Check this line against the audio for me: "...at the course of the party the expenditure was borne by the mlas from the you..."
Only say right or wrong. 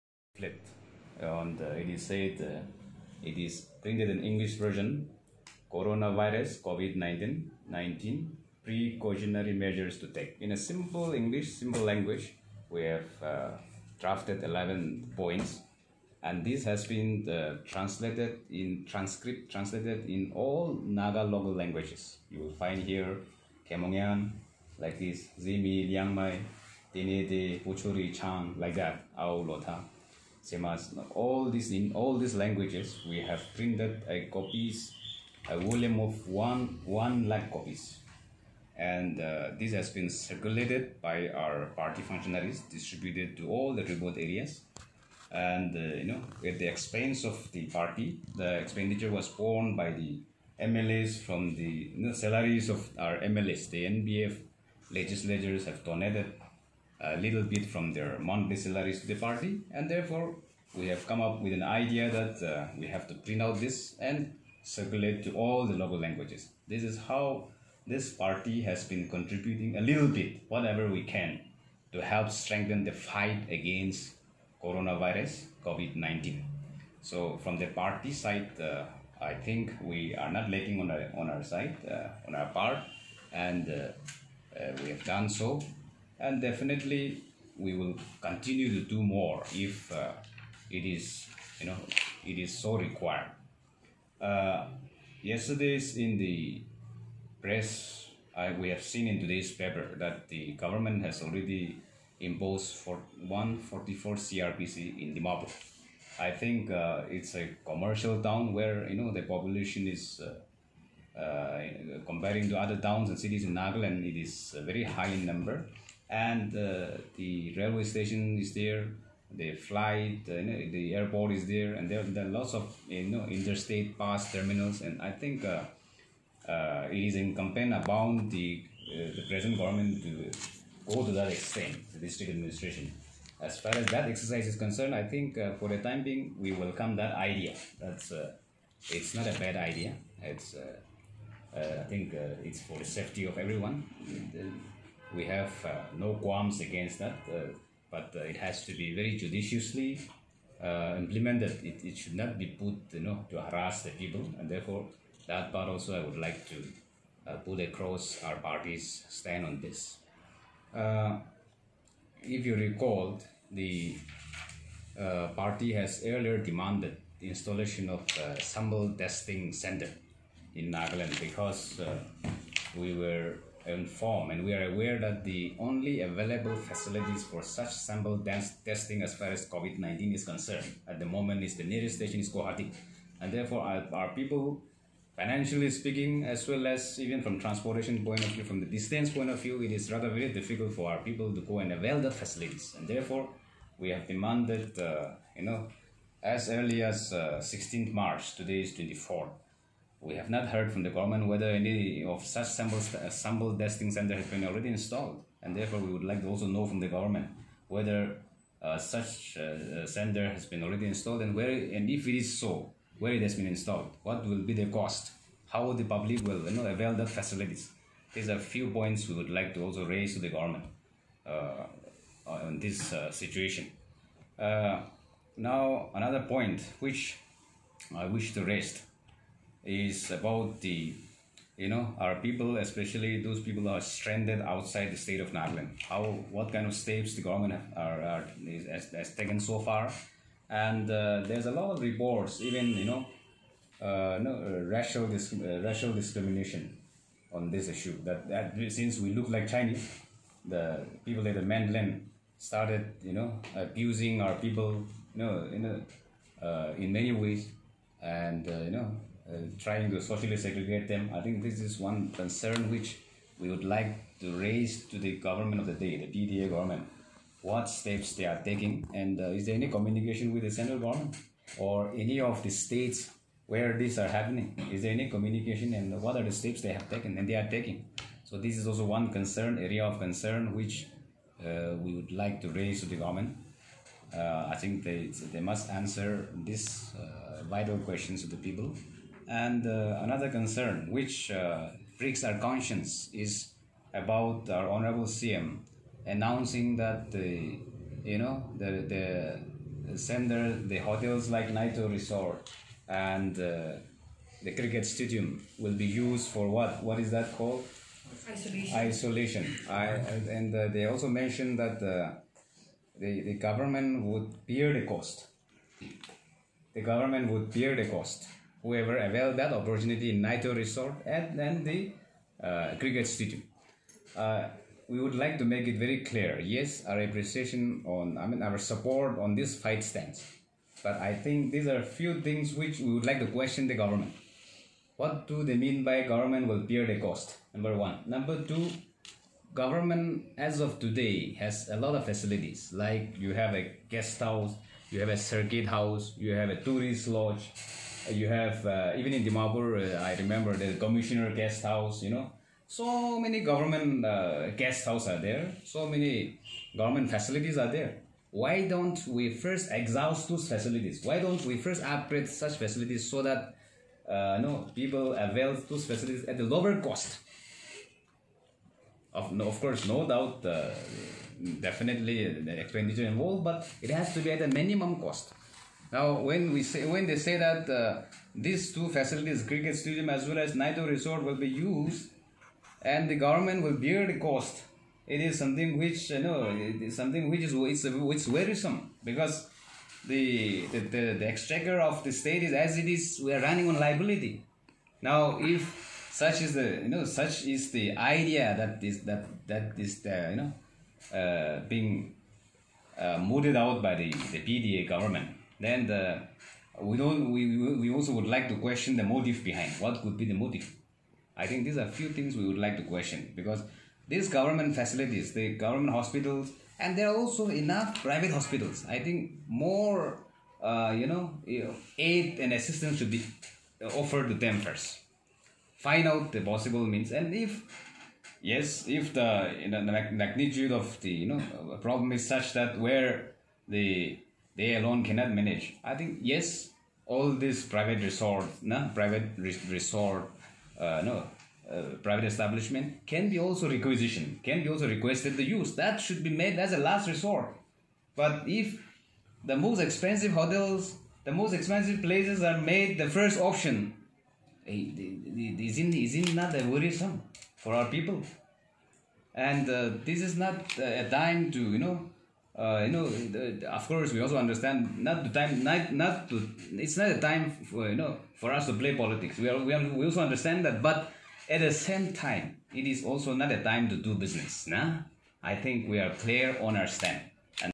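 wrong.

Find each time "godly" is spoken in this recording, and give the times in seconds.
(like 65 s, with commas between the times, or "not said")
not said.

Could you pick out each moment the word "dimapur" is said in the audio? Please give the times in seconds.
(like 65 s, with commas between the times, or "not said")
105 s, 349 s.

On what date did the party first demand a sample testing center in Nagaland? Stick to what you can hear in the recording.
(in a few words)
16 March.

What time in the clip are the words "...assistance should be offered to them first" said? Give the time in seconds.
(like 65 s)
422 s.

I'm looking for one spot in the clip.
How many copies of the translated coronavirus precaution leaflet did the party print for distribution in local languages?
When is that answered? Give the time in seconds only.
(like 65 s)
36 s.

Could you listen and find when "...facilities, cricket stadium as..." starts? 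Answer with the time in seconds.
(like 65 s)
378 s.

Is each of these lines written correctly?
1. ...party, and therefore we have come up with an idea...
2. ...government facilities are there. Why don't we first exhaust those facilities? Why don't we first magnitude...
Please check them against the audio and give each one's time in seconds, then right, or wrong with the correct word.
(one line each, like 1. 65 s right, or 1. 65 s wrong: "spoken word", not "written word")
1. 59 s right
2. 356 s wrong: "upgrade", not "magnitude".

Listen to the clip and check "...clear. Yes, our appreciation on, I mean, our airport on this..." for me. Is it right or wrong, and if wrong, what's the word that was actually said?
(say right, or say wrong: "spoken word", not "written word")
wrong: "support", not "airport".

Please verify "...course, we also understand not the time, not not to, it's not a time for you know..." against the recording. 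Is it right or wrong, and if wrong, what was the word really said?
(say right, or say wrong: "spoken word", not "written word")
right.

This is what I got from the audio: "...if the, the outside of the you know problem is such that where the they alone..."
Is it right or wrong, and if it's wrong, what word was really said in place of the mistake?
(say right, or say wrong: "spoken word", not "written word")
wrong: "magnitude", not "outside".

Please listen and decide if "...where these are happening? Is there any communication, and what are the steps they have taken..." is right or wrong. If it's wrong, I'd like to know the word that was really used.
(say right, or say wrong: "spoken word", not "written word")
right.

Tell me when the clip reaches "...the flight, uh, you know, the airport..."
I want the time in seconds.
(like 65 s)
119 s.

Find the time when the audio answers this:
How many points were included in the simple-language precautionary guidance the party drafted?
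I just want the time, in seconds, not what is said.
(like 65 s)
14 s.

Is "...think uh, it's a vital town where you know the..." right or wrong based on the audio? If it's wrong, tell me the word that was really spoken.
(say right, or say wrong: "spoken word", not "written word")
wrong: "commercial", not "vital".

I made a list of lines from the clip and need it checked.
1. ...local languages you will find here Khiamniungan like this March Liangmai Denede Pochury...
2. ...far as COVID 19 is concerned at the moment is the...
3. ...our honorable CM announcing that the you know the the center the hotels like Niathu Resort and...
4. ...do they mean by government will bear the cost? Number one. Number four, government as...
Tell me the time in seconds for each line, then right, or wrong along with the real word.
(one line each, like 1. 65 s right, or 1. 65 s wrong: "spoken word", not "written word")
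1. 21 s wrong: "Zimi", not "March"
2. 179 s right
3. 294 s right
4. 335 s wrong: "two", not "four".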